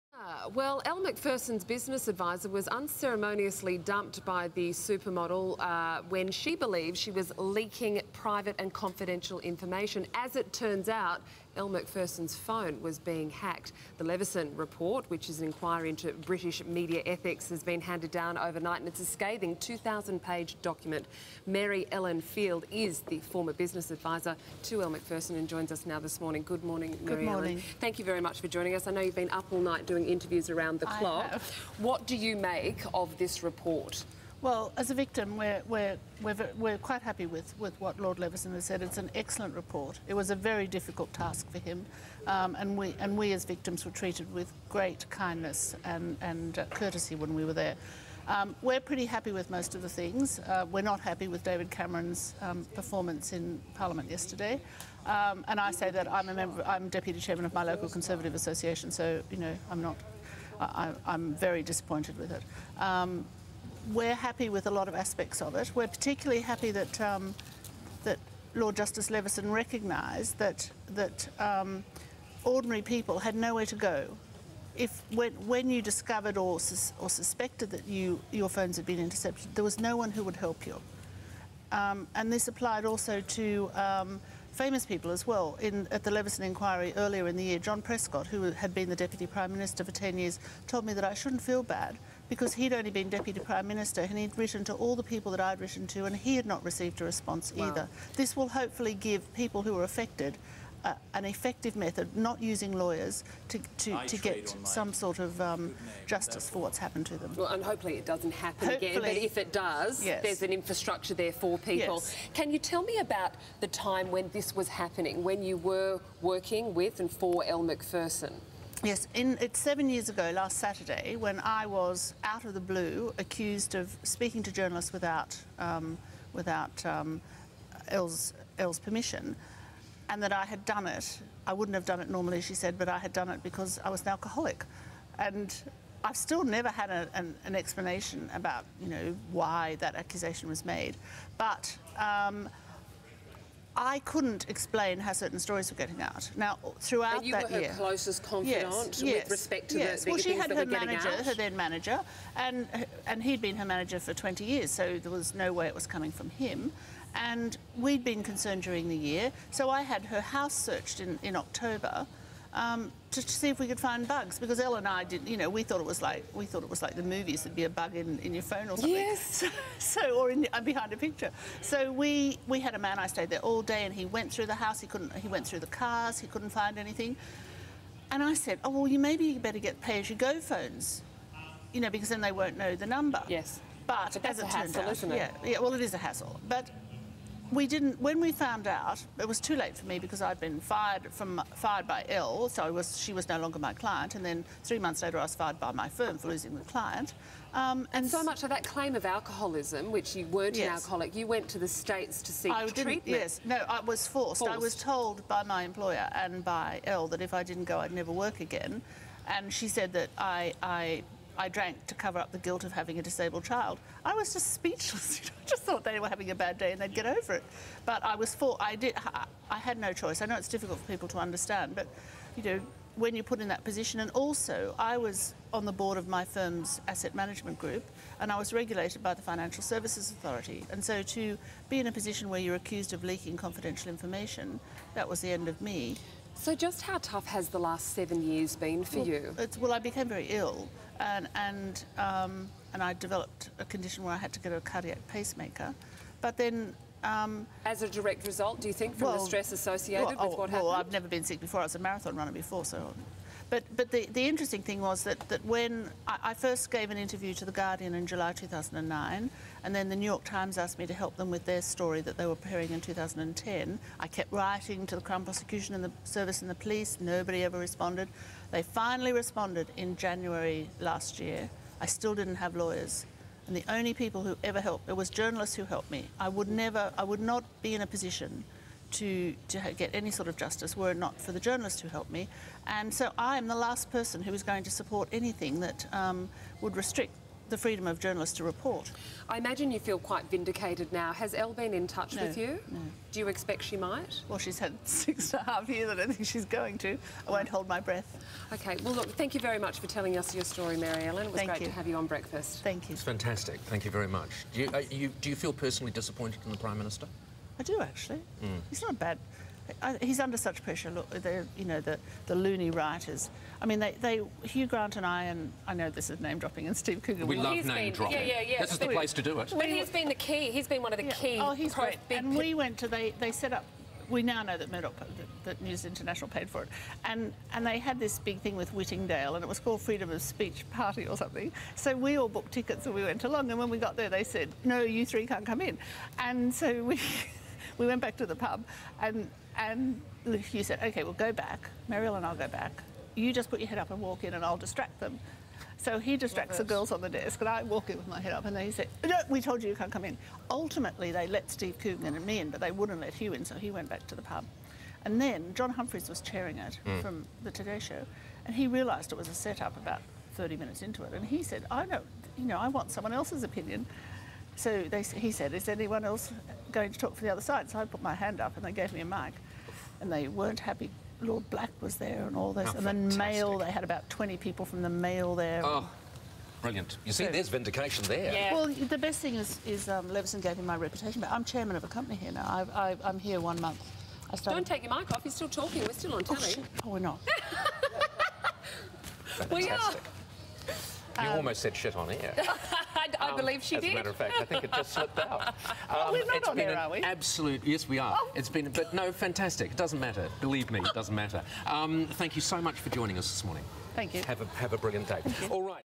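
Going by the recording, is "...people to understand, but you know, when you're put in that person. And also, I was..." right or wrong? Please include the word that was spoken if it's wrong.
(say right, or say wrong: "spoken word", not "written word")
wrong: "position", not "person".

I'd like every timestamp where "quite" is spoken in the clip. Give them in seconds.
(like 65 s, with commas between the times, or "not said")
36 s, 289 s.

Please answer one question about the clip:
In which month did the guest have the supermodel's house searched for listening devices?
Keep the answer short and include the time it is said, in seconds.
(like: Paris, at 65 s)
October, at 161 s.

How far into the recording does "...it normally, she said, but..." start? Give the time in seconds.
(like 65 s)
132 s.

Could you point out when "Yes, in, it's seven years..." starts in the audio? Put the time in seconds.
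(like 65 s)
118 s.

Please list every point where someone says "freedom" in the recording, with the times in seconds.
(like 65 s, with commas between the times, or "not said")
287 s, 329 s.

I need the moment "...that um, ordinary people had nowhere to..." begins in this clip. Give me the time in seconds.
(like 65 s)
70 s.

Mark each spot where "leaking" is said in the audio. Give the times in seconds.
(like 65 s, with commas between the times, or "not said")
7 s, 233 s.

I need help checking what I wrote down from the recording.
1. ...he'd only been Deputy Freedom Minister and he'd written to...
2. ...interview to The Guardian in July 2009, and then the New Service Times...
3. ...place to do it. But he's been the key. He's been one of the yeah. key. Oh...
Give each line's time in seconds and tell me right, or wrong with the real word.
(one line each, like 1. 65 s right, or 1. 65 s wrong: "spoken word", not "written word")
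1. 92 s wrong: "Prime", not "Freedom"
2. 256 s wrong: "York", not "Service"
3. 318 s right.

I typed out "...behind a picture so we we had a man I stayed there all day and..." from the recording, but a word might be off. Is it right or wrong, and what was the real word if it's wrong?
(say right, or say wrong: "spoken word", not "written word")
right.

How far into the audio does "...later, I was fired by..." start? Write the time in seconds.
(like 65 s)
195 s.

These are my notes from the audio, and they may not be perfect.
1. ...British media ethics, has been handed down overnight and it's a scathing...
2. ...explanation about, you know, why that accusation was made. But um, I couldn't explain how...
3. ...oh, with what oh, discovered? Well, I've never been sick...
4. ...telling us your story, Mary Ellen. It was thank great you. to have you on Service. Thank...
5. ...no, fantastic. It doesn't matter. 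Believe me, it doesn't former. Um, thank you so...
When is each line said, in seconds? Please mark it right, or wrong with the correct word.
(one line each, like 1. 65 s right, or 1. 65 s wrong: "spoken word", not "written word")
1. 16 s right
2. 137 s right
3. 250 s wrong: "happened", not "discovered"
4. 299 s wrong: "Breakfast", not "Service"
5. 398 s wrong: "matter", not "former".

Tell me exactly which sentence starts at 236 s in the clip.
So, just how tough has the last seven years been for well, you?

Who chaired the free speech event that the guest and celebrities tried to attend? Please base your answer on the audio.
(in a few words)
John Humphrys.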